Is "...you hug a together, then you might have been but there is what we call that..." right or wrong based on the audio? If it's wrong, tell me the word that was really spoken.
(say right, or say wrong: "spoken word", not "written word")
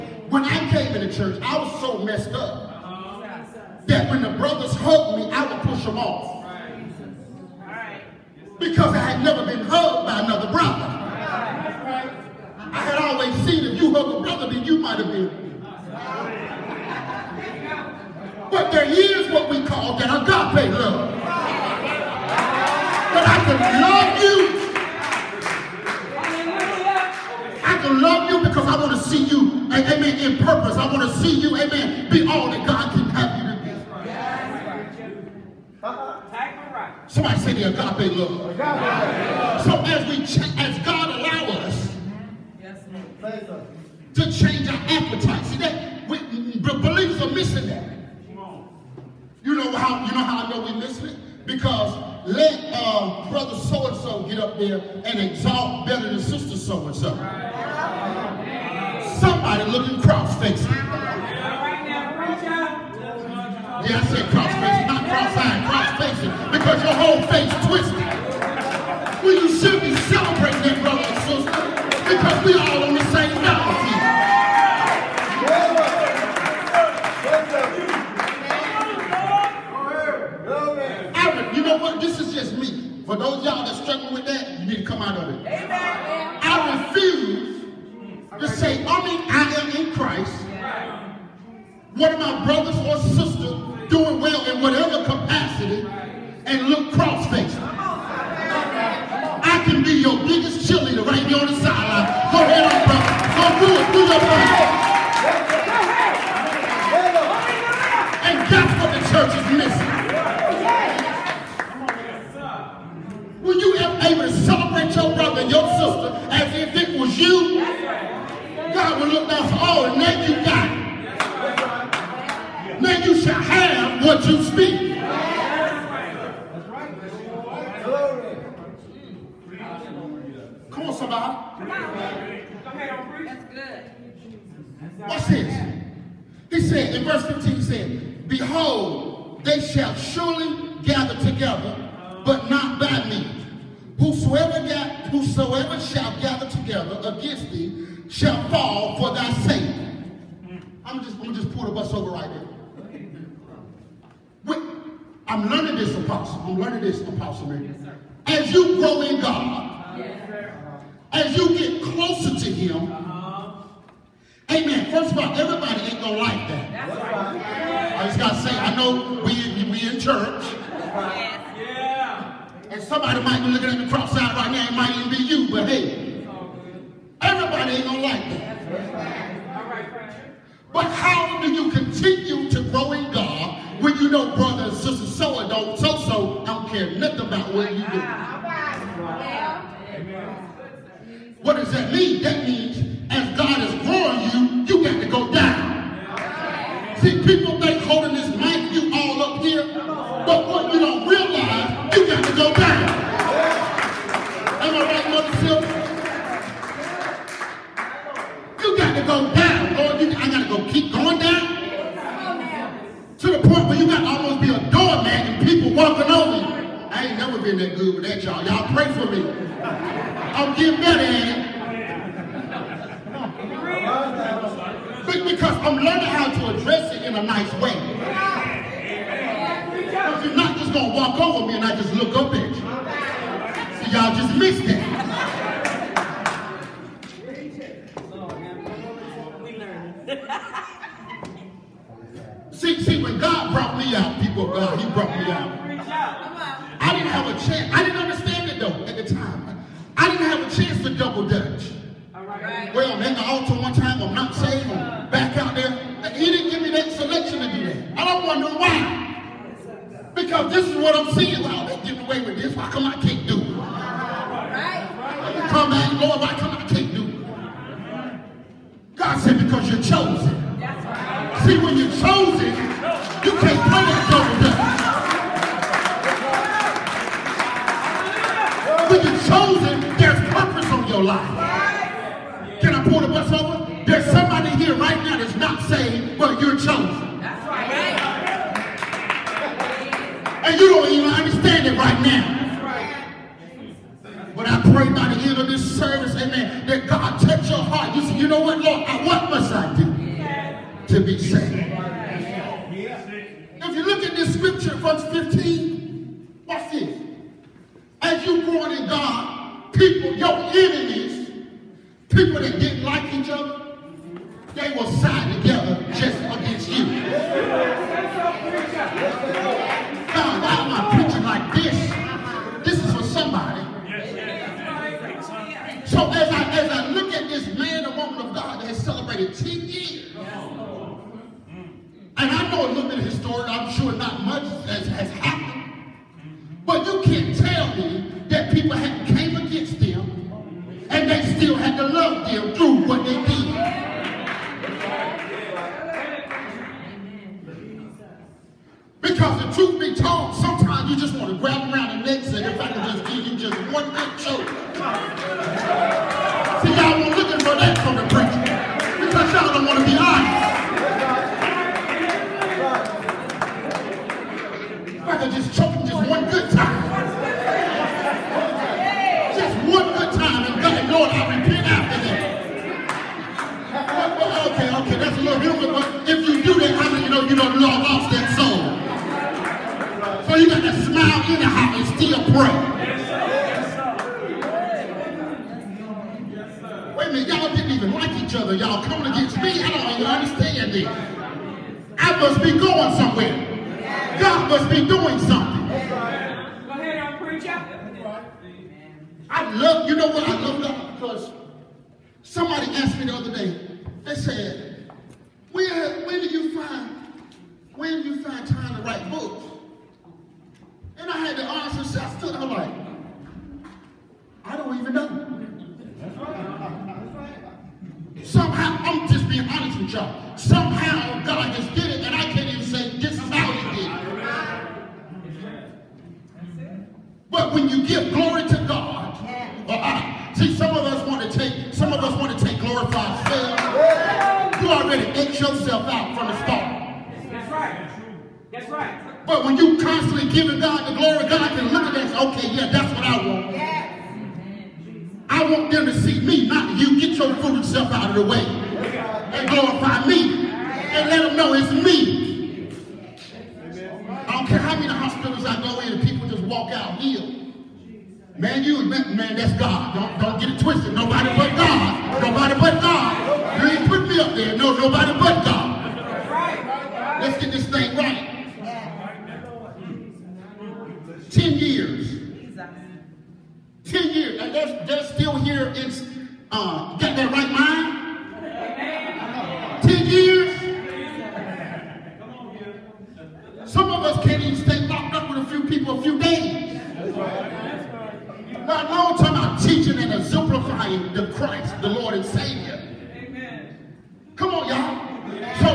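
wrong: "brother", not "together".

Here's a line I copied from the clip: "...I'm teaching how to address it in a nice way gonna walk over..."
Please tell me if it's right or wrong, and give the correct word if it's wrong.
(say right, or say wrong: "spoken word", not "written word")
wrong: "learning", not "teaching".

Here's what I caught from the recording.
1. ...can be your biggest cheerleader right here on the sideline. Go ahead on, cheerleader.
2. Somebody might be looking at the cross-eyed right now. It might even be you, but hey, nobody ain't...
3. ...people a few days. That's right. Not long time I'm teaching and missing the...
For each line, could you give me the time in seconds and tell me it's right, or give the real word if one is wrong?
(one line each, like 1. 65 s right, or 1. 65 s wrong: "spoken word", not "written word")
1. 99 s wrong: "brother", not "cheerleader"
2. 172 s wrong: "everybody", not "nobody"
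3. 485 s wrong: "exemplifying", not "missing".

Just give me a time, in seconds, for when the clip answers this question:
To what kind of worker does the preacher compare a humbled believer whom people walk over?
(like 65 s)
214 s.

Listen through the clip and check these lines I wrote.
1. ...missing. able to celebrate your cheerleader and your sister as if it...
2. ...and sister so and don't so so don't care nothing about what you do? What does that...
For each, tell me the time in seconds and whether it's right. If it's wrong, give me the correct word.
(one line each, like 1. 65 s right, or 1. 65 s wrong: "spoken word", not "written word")
1. 109 s wrong: "brother", not "cheerleader"
2. 184 s right.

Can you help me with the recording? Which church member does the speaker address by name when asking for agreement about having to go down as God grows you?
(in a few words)
Mother Silver.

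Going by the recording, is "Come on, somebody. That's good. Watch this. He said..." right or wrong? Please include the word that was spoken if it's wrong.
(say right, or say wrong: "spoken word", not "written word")
right.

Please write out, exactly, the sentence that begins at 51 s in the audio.
Because let uh, brother so-and-so get up there and exalt better than sister so-and-so.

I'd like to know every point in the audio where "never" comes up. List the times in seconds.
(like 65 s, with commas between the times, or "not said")
9 s, 217 s.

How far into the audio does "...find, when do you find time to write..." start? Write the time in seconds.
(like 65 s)
406 s.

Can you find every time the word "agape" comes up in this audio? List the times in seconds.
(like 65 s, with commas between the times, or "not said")
20 s, 37 s.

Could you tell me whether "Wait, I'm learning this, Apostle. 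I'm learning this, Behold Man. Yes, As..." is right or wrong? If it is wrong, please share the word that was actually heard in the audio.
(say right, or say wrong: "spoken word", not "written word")
wrong: "Apostle", not "Behold".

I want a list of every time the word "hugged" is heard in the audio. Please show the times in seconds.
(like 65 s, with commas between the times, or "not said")
4 s, 9 s.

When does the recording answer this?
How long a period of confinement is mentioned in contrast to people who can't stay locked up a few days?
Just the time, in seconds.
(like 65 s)
471 s.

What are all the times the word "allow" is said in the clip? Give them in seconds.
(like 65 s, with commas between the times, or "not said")
41 s.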